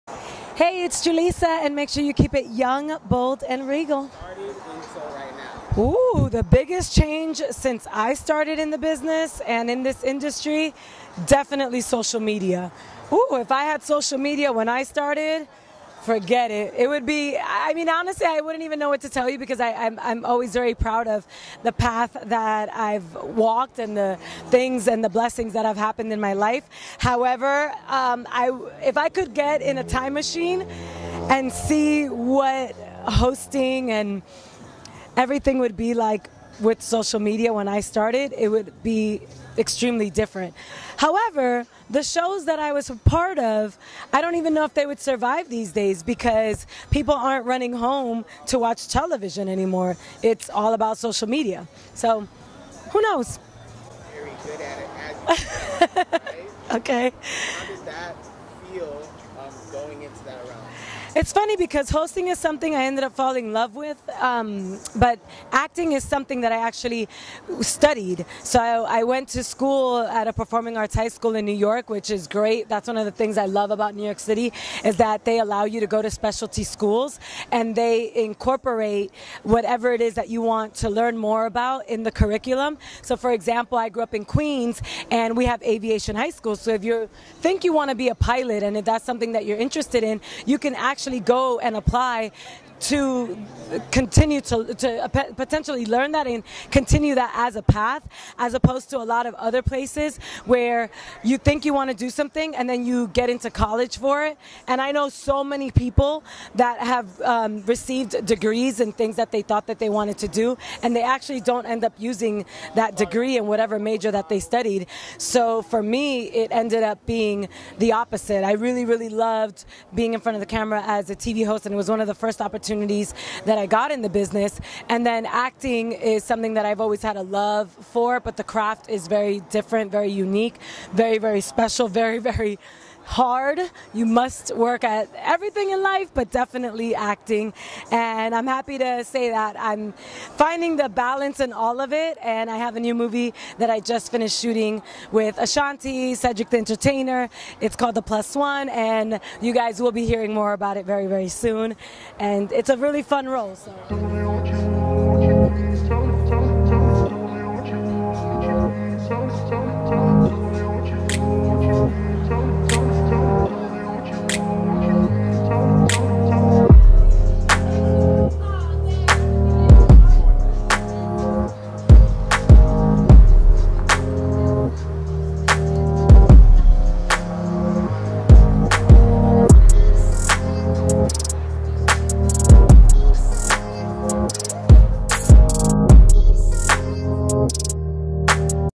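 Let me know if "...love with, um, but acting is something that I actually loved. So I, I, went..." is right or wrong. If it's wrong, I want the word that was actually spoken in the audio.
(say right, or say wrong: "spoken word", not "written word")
wrong: "studied", not "loved".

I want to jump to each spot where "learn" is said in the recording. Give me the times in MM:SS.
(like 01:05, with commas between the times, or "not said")
01:20, 01:35.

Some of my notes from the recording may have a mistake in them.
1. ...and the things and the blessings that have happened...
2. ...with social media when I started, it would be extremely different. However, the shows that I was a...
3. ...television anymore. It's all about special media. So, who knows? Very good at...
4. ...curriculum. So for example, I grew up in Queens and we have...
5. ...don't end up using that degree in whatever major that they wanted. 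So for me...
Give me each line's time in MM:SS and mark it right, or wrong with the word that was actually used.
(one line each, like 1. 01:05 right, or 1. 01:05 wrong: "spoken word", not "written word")
1. 00:23 right
2. 00:36 right
3. 00:48 wrong: "social", not "special"
4. 01:22 right
5. 01:51 wrong: "studied", not "wanted".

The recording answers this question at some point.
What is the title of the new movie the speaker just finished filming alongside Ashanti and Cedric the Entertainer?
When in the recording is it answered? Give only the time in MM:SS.
02:27.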